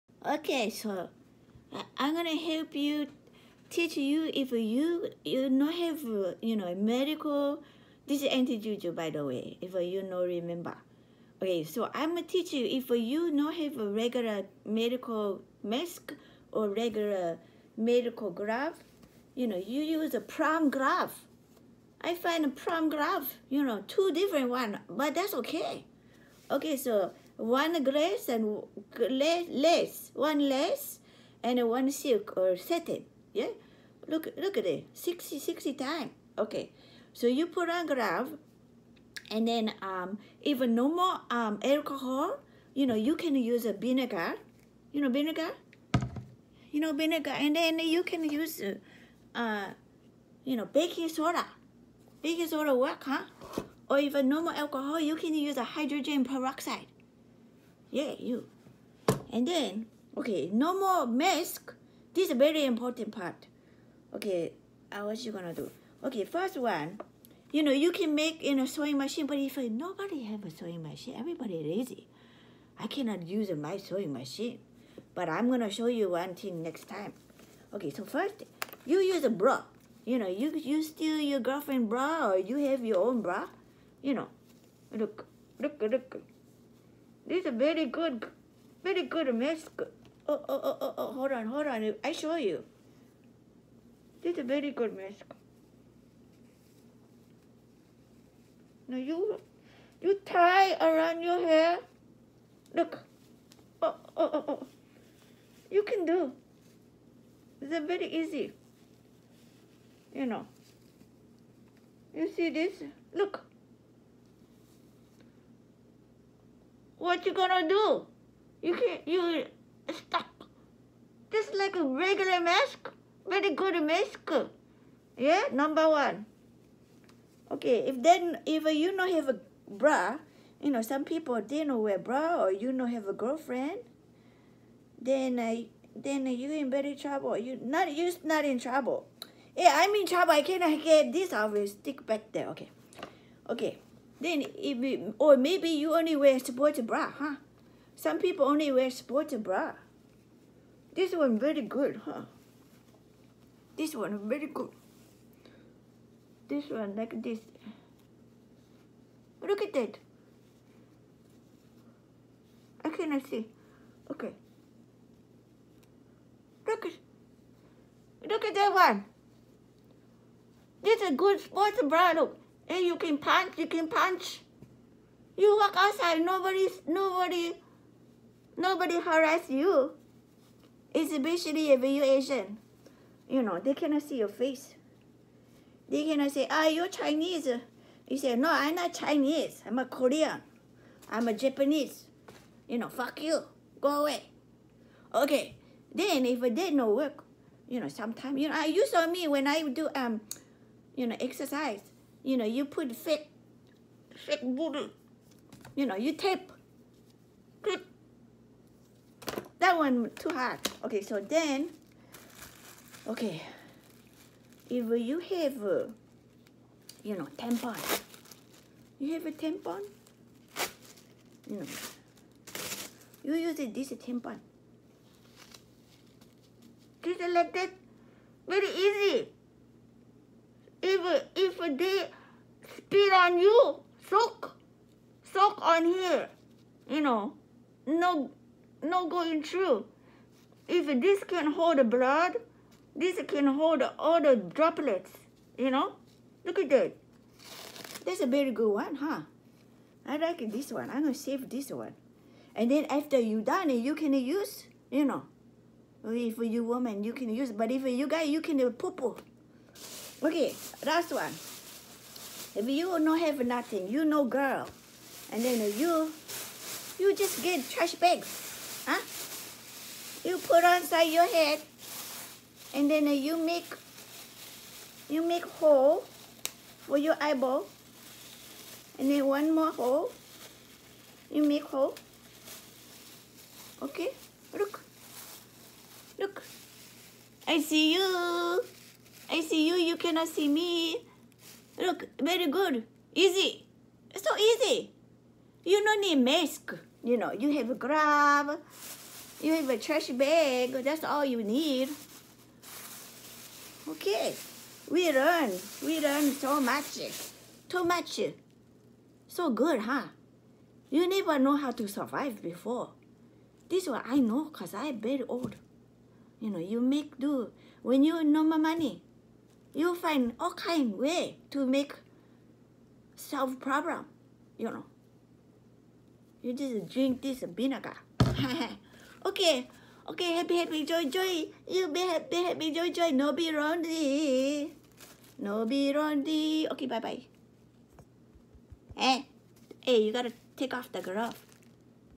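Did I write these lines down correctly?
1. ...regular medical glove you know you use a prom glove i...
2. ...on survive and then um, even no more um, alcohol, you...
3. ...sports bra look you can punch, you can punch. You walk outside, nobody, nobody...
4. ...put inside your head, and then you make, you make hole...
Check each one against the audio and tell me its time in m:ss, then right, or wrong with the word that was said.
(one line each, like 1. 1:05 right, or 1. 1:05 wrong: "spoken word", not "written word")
1. 0:16 right
2. 0:37 wrong: "glove", not "survive"
3. 2:51 right
4. 4:30 right.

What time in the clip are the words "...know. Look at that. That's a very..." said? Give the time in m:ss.
4:05.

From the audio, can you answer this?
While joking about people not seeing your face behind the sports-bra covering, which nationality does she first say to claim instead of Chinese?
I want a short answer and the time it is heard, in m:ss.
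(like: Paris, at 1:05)
Korean, at 3:09.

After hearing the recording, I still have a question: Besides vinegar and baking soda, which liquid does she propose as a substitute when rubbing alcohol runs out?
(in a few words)
Hydrogen peroxide.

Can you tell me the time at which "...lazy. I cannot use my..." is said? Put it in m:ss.
1:11.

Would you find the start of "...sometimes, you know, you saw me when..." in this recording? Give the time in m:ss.
3:17.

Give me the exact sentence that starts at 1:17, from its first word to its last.
Okay, so first, you use a bra.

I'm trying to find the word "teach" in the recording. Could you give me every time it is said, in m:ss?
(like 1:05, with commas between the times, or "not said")
0:03, 0:12.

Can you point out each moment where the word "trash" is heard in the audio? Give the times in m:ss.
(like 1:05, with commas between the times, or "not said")
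4:27, 4:59.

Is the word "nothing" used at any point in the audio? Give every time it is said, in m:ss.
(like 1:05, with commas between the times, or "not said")
4:23.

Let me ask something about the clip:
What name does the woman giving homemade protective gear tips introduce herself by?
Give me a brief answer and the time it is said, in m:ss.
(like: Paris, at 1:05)
Aunty Juju, at 0:08.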